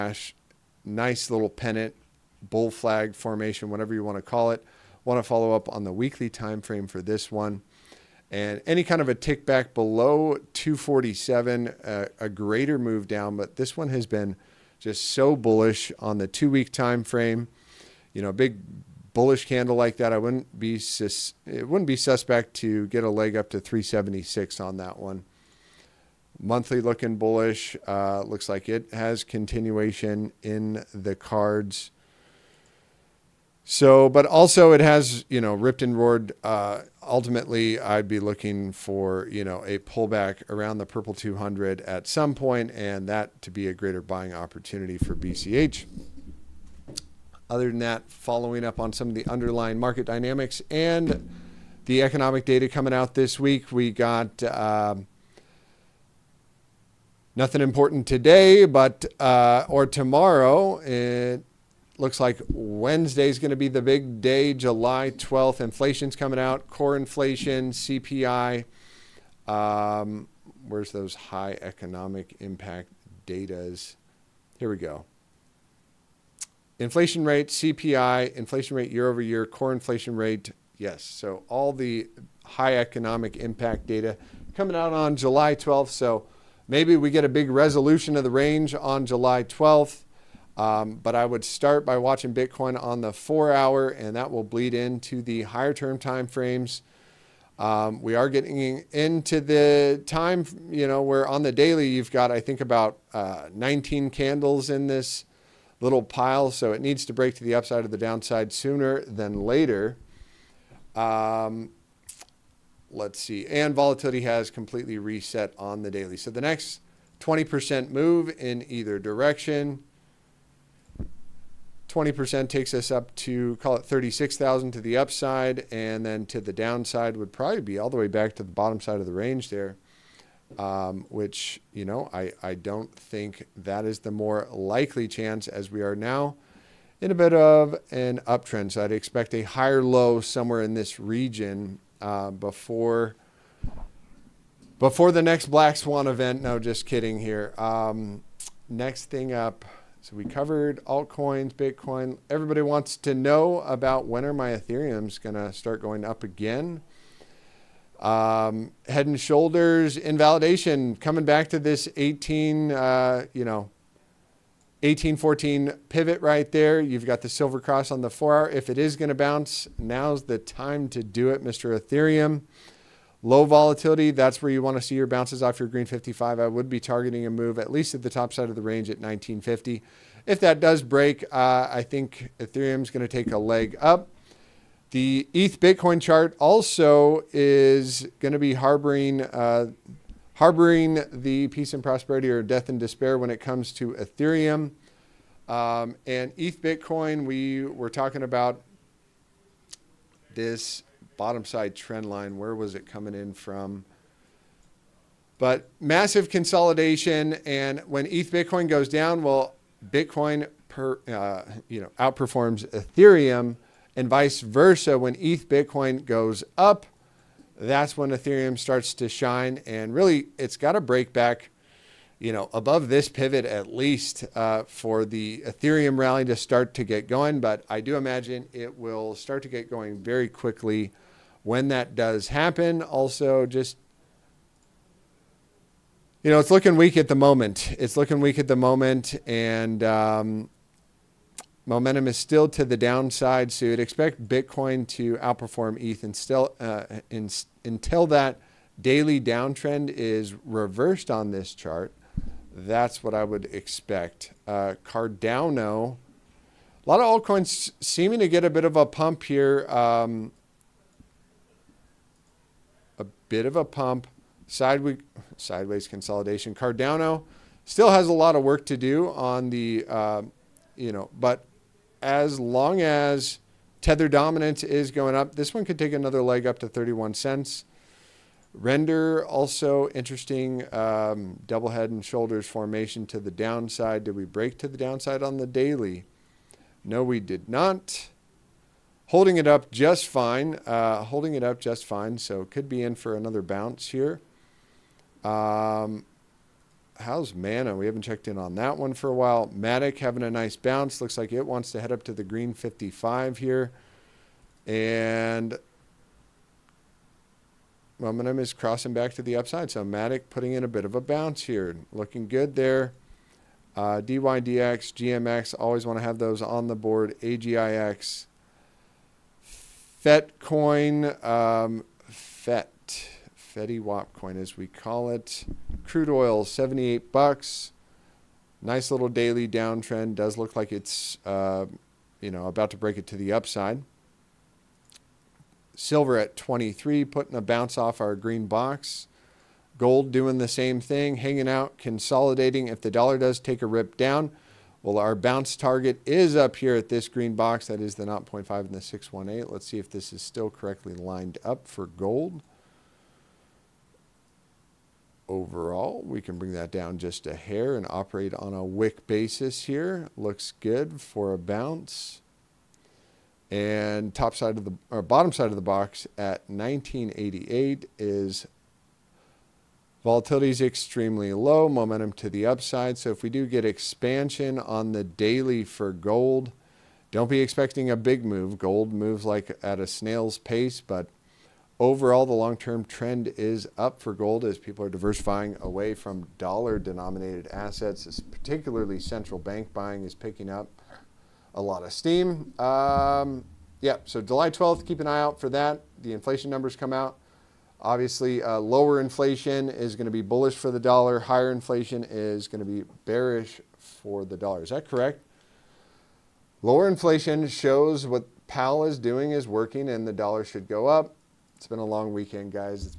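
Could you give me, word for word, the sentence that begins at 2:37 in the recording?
Um, head and shoulders invalidation coming back to this 18, uh, you know, 1814 pivot right there.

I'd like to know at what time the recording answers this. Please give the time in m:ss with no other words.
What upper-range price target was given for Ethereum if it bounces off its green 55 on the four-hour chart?
2:58.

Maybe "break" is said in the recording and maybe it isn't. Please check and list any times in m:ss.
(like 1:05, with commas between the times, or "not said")
1:47, 3:00, 3:40, 4:44, 5:32.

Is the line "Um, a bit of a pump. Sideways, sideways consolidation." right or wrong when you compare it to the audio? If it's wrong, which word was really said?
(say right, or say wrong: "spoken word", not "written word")
right.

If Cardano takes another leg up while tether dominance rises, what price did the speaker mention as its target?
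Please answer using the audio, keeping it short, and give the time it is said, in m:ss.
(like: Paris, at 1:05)
31 cents, at 4:36.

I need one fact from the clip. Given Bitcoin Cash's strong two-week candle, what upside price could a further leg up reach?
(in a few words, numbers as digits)
376.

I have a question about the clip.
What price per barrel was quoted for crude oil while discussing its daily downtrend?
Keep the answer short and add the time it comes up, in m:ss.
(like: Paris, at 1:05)
78 dollars, at 5:26.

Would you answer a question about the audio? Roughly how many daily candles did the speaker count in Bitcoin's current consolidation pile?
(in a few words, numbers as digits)
19.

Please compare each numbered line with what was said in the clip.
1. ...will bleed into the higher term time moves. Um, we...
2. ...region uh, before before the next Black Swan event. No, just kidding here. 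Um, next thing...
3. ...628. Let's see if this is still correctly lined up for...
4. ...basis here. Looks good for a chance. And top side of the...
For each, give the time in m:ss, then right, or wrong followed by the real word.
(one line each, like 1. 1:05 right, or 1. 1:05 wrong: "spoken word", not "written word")
1. 1:34 wrong: "frames", not "moves"
2. 2:20 right
3. 5:48 wrong: "618", not "628"
4. 5:59 wrong: "bounce", not "chance".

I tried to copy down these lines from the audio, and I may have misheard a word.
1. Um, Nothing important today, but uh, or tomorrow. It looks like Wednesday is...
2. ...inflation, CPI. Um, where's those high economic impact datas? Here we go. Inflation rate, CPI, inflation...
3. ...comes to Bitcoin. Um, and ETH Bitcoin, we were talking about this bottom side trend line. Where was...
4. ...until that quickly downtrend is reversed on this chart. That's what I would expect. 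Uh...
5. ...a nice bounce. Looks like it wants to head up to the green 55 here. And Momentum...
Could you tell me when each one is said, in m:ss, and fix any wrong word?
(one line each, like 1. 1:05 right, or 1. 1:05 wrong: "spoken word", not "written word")
1. 0:54 right
2. 1:06 right
3. 3:13 wrong: "Ethereum", not "Bitcoin"
4. 4:07 wrong: "daily", not "quickly"
5. 5:00 right.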